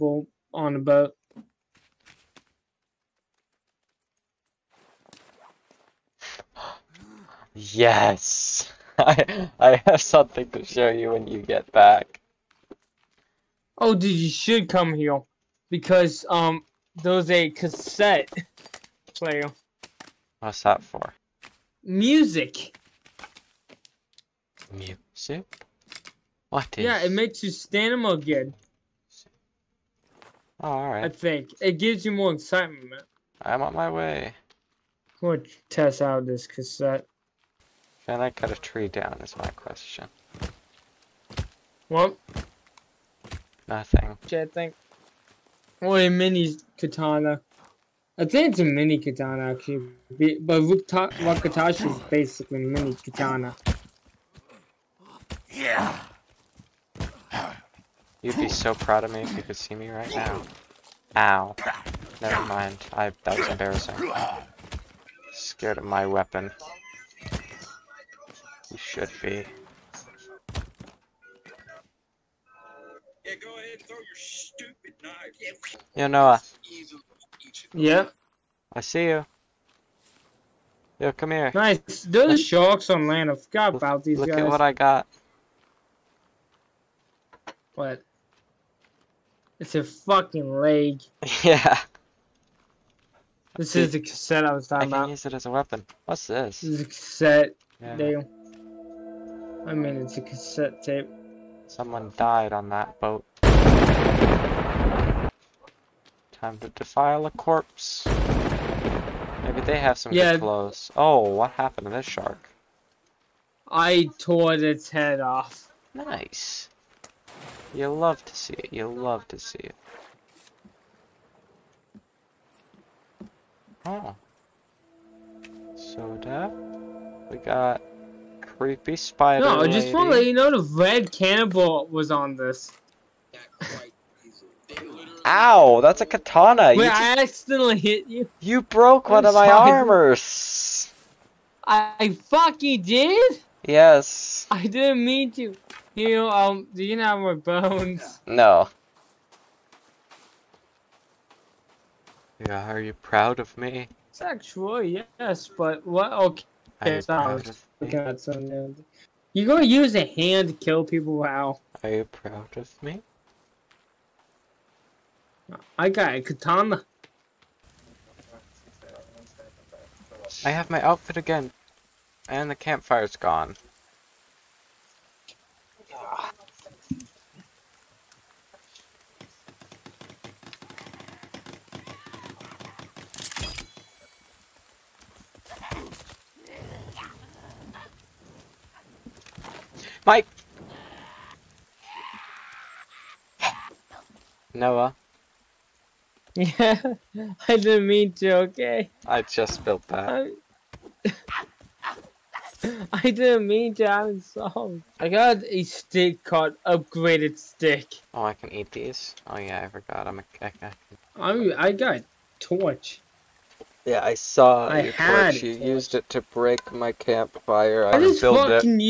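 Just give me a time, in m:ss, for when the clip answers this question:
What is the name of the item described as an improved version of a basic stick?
3:26.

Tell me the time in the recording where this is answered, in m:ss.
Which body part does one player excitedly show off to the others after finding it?
1:30.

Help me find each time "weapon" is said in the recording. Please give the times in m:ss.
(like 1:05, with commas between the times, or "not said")
1:06, 1:35.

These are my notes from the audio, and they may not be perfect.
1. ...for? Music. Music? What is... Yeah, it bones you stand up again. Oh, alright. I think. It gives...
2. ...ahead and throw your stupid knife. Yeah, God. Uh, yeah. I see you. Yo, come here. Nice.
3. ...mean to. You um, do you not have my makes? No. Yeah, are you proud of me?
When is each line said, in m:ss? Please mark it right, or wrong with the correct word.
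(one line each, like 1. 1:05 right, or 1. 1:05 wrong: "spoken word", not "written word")
1. 0:20 wrong: "makes", not "bones"
2. 1:13 wrong: "Noah", not "God"
3. 2:25 wrong: "bones", not "makes".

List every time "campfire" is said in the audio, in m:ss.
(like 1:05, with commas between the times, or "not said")
2:52, 3:36.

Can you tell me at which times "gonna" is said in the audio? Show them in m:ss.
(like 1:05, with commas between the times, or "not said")
0:35, 2:39.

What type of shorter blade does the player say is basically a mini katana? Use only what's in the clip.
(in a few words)
Wakatashi.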